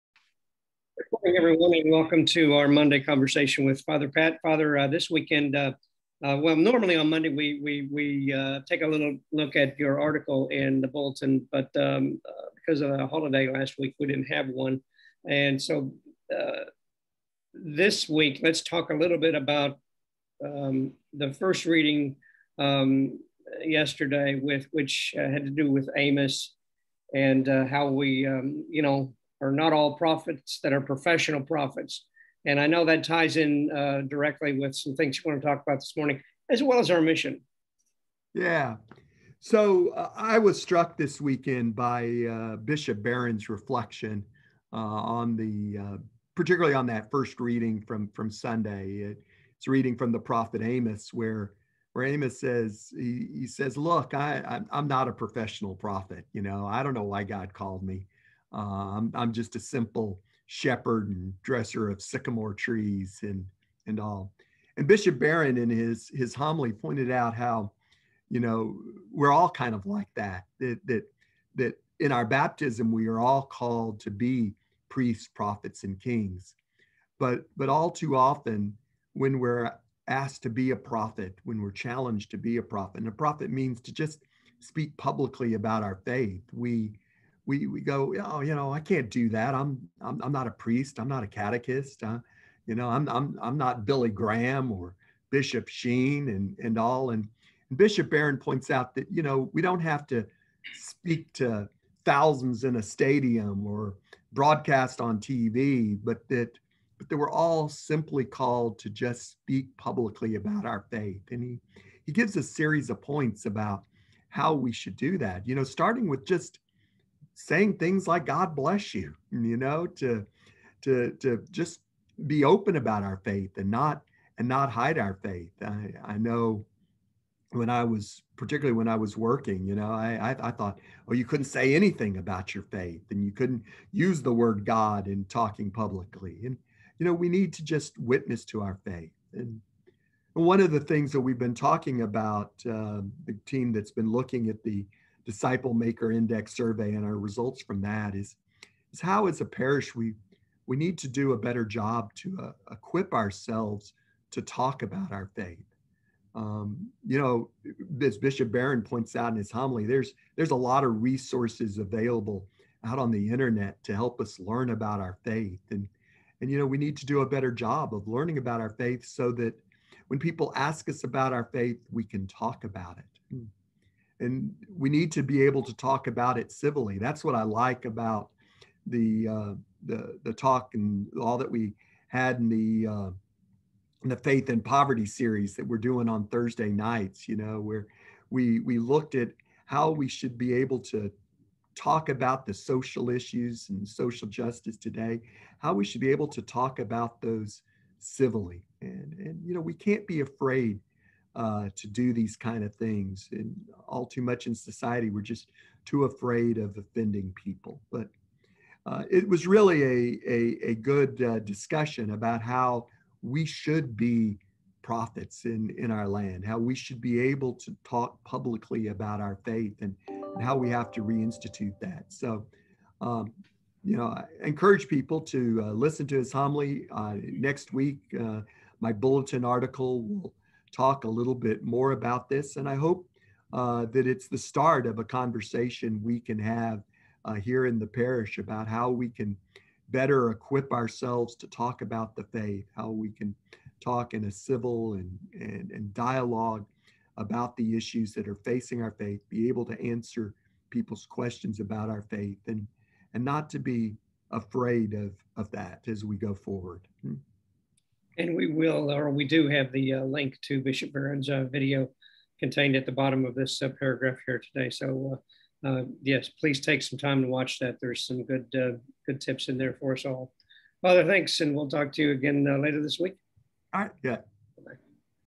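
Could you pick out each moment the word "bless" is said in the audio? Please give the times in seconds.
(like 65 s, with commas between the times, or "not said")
118 s.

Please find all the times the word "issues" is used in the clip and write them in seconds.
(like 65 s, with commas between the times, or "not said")
193 s, 247 s.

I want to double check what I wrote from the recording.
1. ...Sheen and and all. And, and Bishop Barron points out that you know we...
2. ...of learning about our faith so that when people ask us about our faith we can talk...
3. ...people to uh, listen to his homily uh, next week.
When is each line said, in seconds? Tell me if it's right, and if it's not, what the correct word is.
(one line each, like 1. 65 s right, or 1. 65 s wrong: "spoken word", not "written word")
1. 95 s right
2. 167 s right
3. 224 s right.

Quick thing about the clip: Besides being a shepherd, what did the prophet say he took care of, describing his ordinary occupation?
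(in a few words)
sycamore trees.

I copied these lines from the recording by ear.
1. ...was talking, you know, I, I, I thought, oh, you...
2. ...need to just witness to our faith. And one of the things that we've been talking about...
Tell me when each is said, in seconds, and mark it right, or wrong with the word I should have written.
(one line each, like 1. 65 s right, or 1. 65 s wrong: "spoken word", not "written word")
1. 128 s wrong: "working", not "talking"
2. 137 s right.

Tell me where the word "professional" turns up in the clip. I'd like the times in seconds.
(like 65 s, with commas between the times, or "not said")
30 s, 55 s.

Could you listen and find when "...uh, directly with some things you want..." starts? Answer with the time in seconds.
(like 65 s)
33 s.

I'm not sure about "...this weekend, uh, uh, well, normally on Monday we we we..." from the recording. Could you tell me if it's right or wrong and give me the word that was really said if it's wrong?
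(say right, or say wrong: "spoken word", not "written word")
right.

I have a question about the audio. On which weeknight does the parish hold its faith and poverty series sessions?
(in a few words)
Thursday.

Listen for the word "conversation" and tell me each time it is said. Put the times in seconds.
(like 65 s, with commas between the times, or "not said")
2 s, 235 s.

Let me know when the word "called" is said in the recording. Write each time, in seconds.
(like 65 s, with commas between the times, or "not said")
57 s, 73 s, 108 s.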